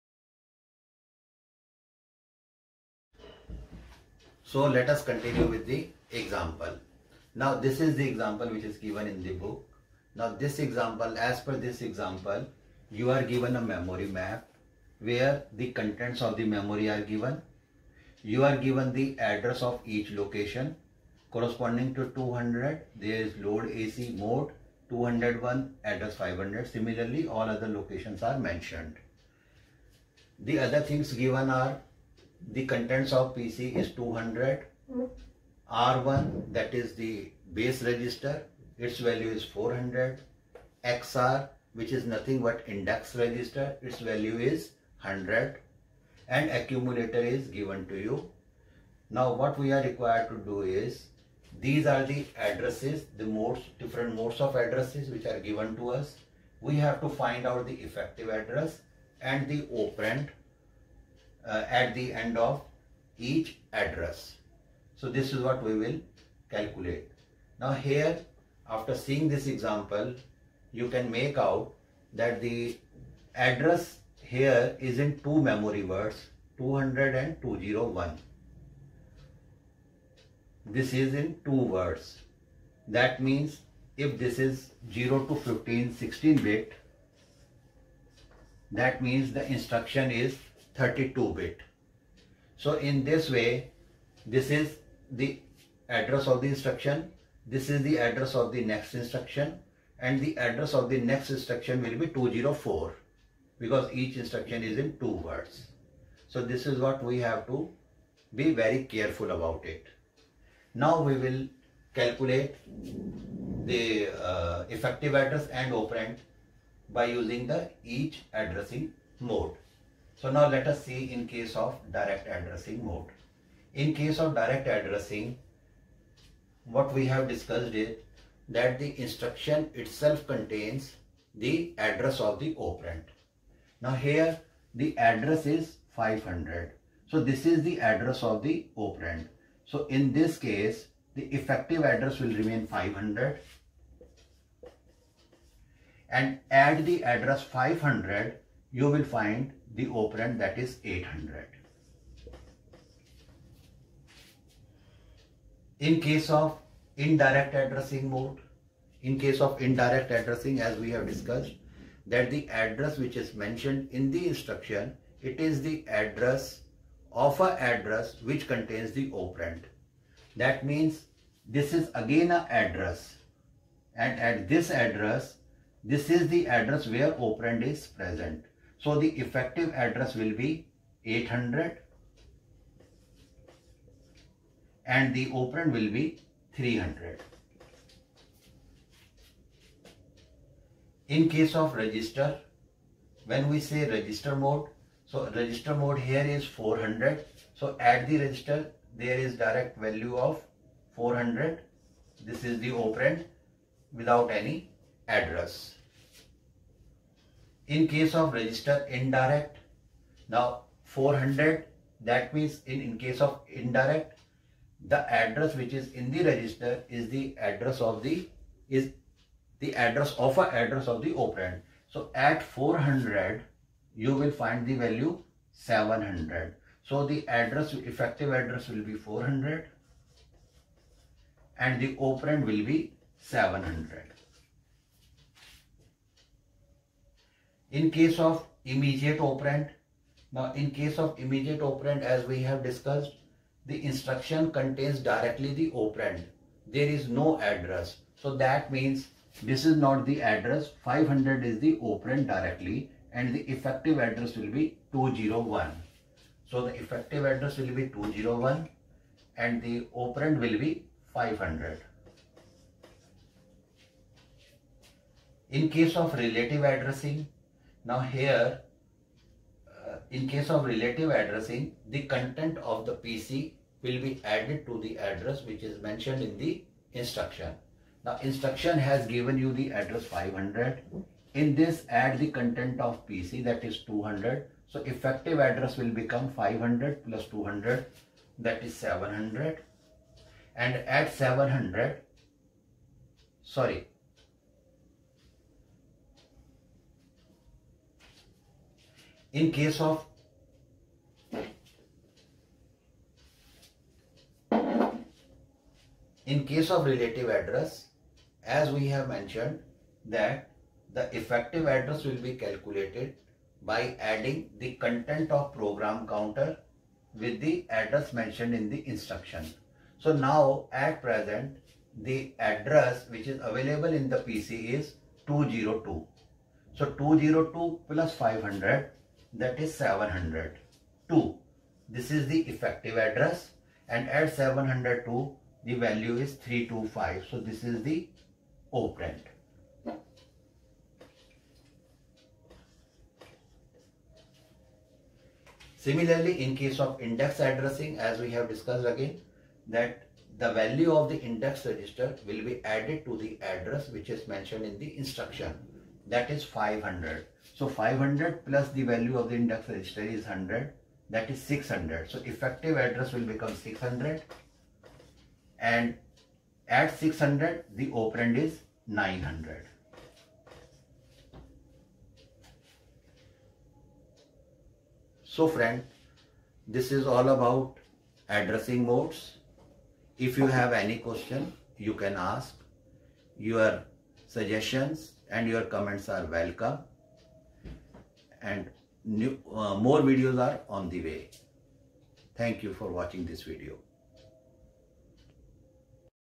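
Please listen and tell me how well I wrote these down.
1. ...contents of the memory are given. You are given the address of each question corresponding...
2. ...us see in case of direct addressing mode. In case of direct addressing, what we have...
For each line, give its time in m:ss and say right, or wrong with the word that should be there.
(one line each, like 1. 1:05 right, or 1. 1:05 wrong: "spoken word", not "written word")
1. 0:15 wrong: "location", not "question"
2. 2:00 right.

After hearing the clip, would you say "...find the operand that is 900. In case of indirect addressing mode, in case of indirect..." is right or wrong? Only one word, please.
wrong.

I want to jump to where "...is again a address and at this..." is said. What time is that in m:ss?
2:51.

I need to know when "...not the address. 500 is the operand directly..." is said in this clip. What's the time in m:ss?
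4:09.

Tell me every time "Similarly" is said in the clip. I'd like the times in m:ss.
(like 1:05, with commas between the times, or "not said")
0:26, 5:45.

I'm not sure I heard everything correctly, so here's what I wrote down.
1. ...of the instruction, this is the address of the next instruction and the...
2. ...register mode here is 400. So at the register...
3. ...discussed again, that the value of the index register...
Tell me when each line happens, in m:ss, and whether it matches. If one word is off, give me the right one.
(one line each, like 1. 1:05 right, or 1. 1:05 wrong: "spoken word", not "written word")
1. 1:36 right
2. 3:15 right
3. 5:48 right.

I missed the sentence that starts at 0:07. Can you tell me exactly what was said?
Now this is the example which is given in the book.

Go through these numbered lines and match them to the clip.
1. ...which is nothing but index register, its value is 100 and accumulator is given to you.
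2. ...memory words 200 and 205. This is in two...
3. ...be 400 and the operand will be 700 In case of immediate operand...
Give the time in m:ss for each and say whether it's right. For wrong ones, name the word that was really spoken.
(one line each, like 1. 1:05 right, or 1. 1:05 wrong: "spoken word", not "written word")
1. 0:41 right
2. 1:15 wrong: "201", not "205"
3. 3:48 right.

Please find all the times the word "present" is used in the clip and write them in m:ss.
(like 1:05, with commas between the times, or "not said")
2:57, 5:21.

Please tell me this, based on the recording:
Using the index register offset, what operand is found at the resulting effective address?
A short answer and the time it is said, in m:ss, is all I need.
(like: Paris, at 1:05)
900, at 6:08.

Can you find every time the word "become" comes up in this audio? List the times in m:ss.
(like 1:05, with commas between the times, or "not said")
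4:45, 6:03.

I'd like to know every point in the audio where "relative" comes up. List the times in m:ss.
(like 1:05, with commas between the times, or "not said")
4:26, 4:30, 5:06.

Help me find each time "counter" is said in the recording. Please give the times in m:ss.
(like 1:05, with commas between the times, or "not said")
5:16.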